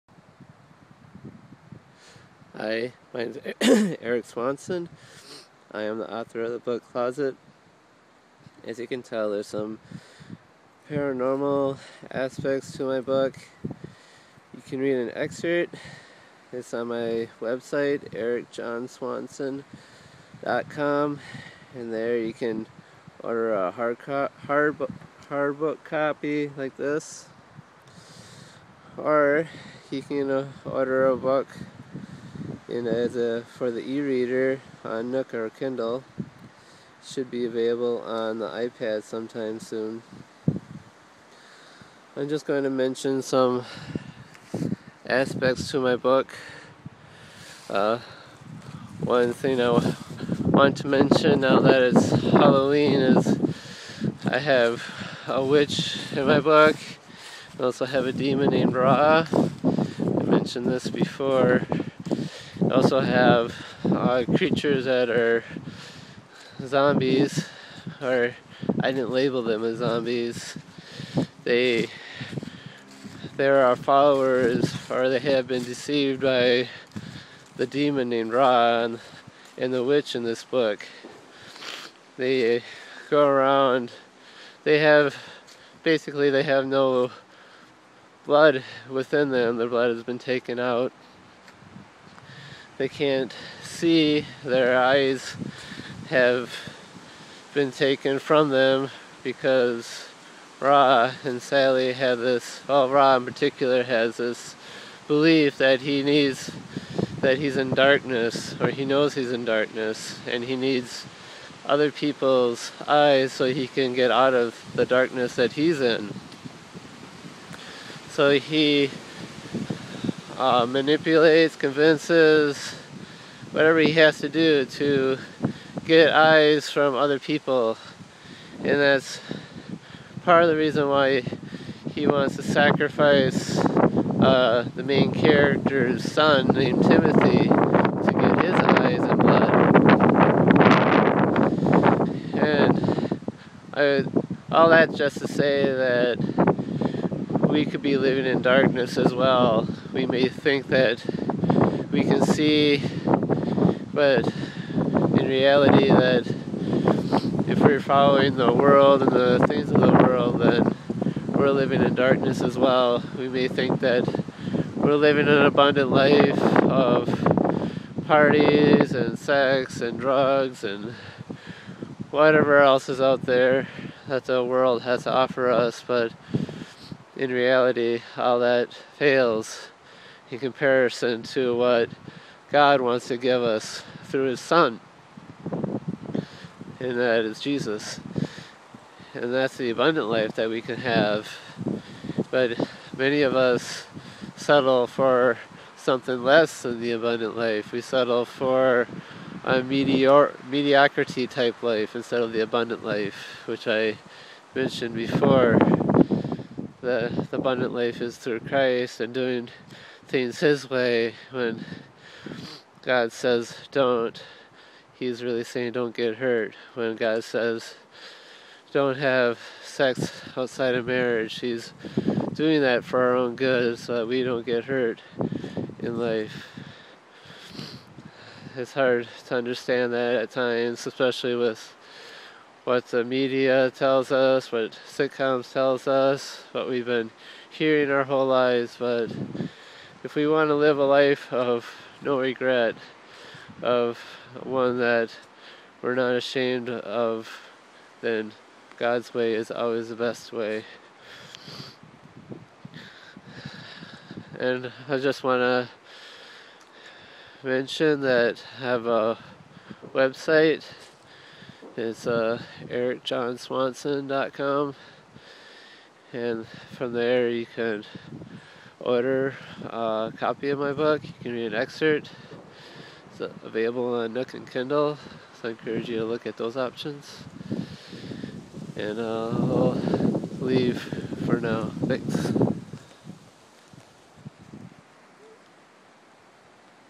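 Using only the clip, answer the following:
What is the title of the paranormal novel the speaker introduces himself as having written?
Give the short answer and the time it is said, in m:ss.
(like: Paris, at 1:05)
Closet, at 0:06.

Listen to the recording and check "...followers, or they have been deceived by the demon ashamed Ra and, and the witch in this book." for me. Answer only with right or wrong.
wrong.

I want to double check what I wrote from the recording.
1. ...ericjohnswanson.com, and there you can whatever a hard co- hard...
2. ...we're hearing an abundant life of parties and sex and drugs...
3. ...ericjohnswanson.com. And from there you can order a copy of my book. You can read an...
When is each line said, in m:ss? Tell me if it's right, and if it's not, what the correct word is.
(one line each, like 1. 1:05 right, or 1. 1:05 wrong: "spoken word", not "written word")
1. 0:18 wrong: "order", not "whatever"
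2. 2:44 wrong: "living", not "hearing"
3. 4:22 right.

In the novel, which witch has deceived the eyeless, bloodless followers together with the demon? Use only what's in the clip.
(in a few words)
Sally.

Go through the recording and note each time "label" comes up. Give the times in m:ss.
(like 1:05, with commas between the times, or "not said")
1:09.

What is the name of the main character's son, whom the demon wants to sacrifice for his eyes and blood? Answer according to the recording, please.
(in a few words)
Timothy.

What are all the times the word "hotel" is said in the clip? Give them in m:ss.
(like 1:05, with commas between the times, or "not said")
not said.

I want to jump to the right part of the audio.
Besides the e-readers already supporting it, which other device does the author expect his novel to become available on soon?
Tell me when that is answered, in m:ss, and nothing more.
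0:38.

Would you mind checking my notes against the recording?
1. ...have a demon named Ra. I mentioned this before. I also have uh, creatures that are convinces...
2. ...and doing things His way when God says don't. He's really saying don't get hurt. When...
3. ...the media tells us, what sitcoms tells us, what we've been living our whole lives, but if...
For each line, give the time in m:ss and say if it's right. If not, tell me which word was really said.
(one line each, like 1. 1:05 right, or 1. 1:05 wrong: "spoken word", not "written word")
1. 0:57 wrong: "zombies", not "convinces"
2. 3:29 right
3. 3:52 wrong: "hearing", not "living".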